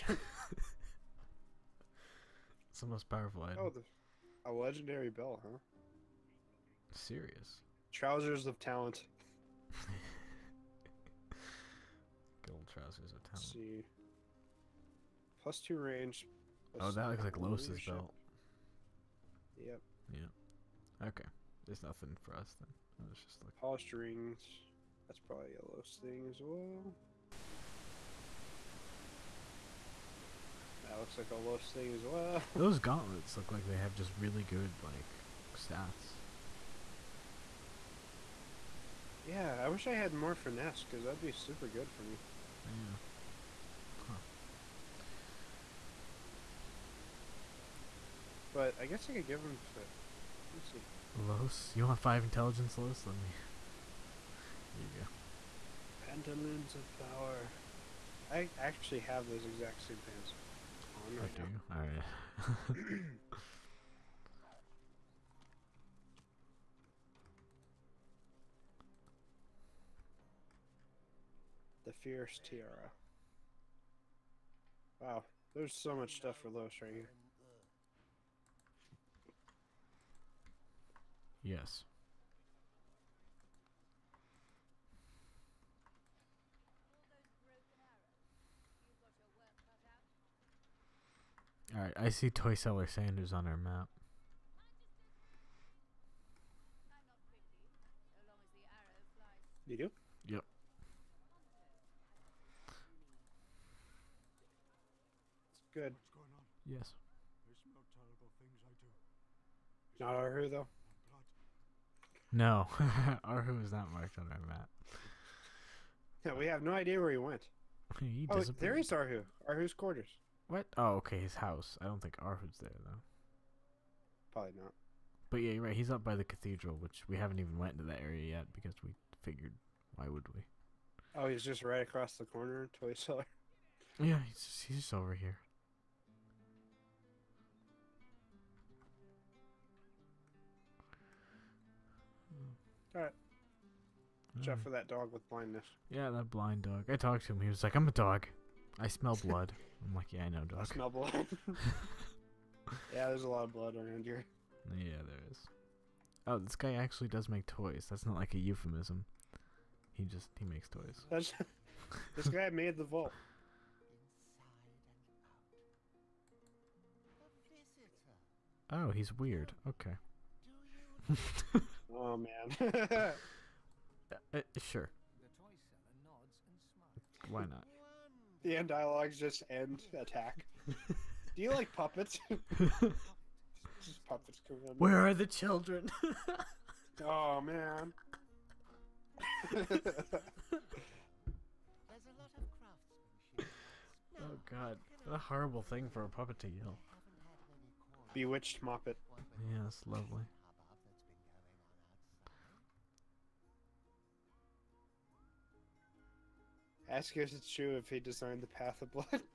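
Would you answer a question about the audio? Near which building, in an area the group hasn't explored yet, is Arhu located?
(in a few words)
The cathedral.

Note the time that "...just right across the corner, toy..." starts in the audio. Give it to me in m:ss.
2:11.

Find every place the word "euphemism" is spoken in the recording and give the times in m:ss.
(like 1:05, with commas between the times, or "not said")
2:38.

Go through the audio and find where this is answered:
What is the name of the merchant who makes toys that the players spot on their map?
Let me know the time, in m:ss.
1:32.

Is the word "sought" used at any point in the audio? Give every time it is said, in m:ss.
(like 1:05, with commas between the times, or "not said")
not said.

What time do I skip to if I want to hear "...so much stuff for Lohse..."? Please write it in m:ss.
1:15.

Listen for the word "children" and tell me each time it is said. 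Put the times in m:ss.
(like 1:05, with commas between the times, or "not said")
3:05.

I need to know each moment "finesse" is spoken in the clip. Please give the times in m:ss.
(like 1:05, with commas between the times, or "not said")
0:40.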